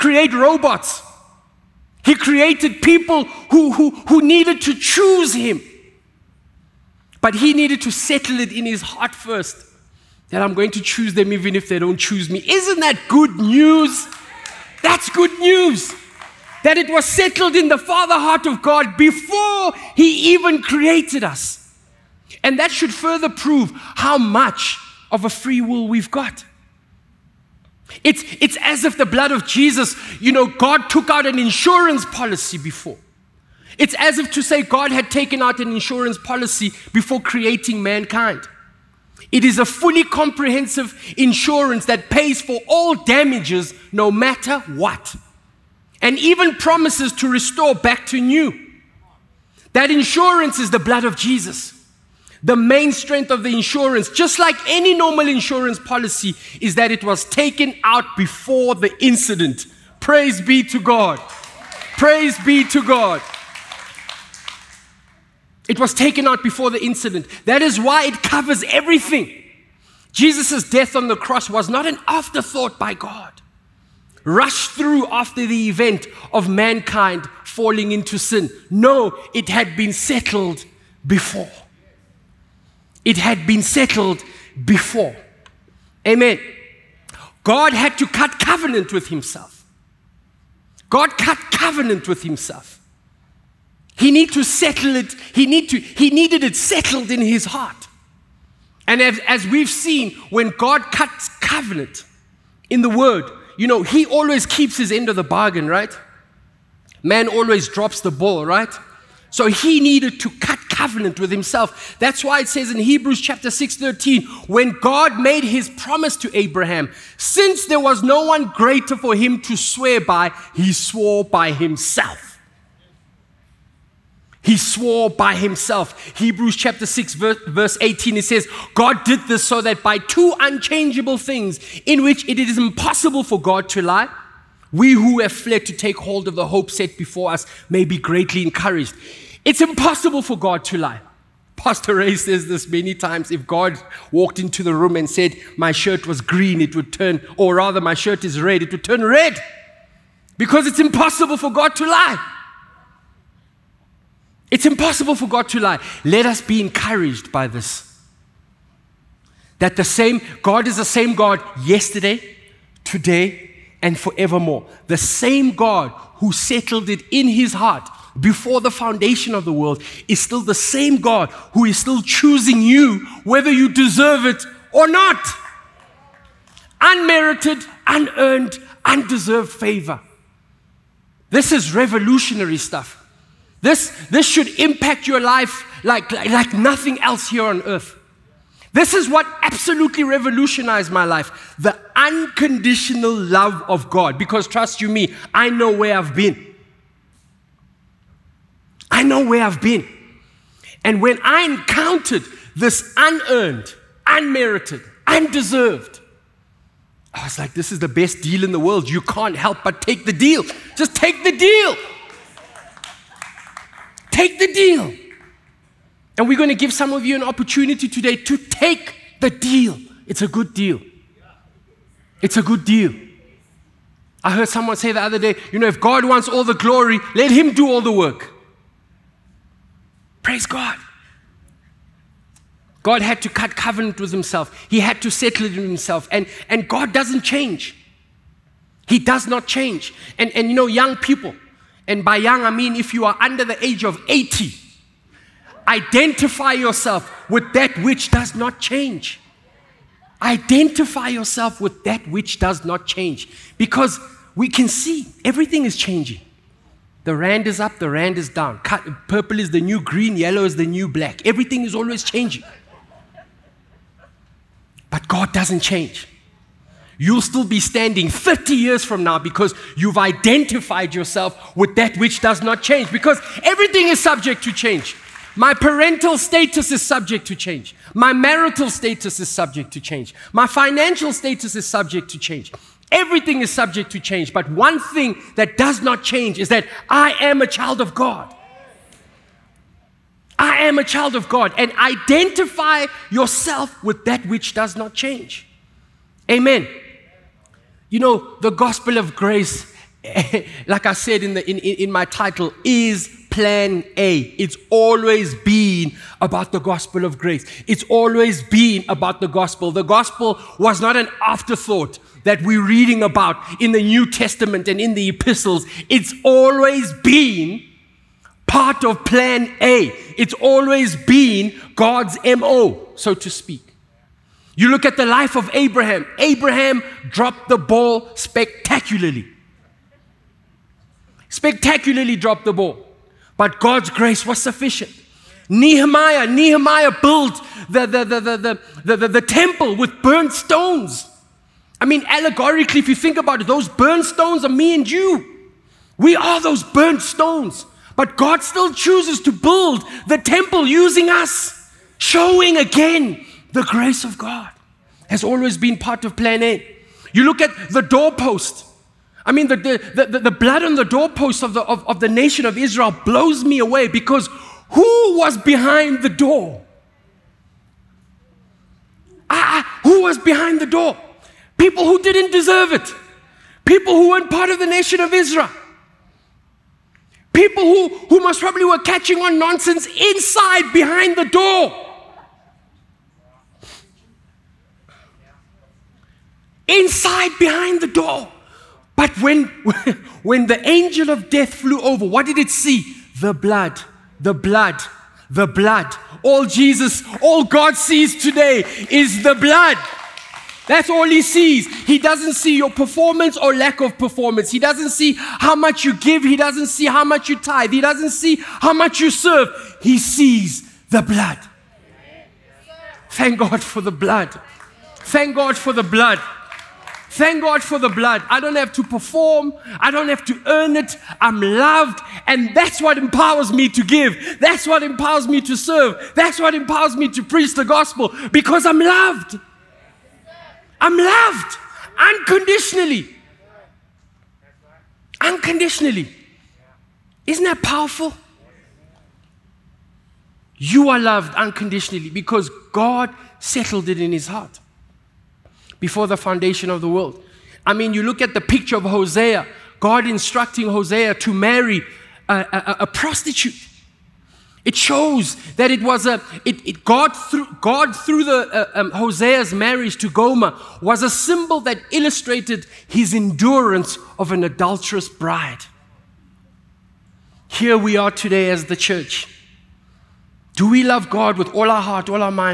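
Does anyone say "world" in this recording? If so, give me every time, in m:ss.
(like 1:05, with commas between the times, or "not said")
2:49, 3:28, 7:26.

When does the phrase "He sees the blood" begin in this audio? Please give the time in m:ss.
6:49.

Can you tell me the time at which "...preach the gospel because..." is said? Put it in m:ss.
7:07.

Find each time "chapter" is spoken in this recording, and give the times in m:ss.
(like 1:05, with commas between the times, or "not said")
1:53, 2:06.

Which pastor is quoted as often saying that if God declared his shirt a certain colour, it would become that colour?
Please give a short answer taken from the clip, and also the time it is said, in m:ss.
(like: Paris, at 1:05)
Pastor Ray, at 2:21.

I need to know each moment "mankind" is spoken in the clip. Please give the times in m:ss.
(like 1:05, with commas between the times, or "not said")
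0:37, 1:16.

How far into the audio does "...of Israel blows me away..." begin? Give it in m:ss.
6:02.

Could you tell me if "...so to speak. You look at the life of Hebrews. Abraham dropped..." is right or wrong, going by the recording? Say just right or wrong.
wrong.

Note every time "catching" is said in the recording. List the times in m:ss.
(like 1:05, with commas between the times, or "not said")
6:18.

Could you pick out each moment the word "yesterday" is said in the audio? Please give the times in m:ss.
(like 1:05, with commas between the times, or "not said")
2:41.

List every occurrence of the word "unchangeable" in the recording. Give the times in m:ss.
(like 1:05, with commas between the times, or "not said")
2:10.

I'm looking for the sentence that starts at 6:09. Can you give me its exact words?
Ah, ah, who was behind the door?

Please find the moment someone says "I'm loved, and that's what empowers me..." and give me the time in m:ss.
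7:01.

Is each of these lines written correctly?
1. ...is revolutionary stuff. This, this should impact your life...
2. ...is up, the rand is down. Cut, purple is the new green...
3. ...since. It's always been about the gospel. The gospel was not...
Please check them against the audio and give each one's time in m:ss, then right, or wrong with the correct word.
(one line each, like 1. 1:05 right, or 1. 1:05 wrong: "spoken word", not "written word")
1. 3:01 right
2. 4:17 right
3. 5:07 wrong: "grace", not "since".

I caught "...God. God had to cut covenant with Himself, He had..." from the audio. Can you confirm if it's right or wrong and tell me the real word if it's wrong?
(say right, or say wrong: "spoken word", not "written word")
right.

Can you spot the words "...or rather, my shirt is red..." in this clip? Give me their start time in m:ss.
2:27.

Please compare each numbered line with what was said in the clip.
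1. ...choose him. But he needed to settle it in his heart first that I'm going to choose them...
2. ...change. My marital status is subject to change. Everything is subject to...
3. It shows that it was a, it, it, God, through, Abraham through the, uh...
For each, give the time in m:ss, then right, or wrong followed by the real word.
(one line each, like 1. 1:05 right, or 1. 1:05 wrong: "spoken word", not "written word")
1. 0:04 right
2. 4:39 wrong: "financial", not "marital"
3. 7:34 wrong: "God", not "Abraham".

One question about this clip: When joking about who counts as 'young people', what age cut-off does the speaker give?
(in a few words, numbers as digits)
80.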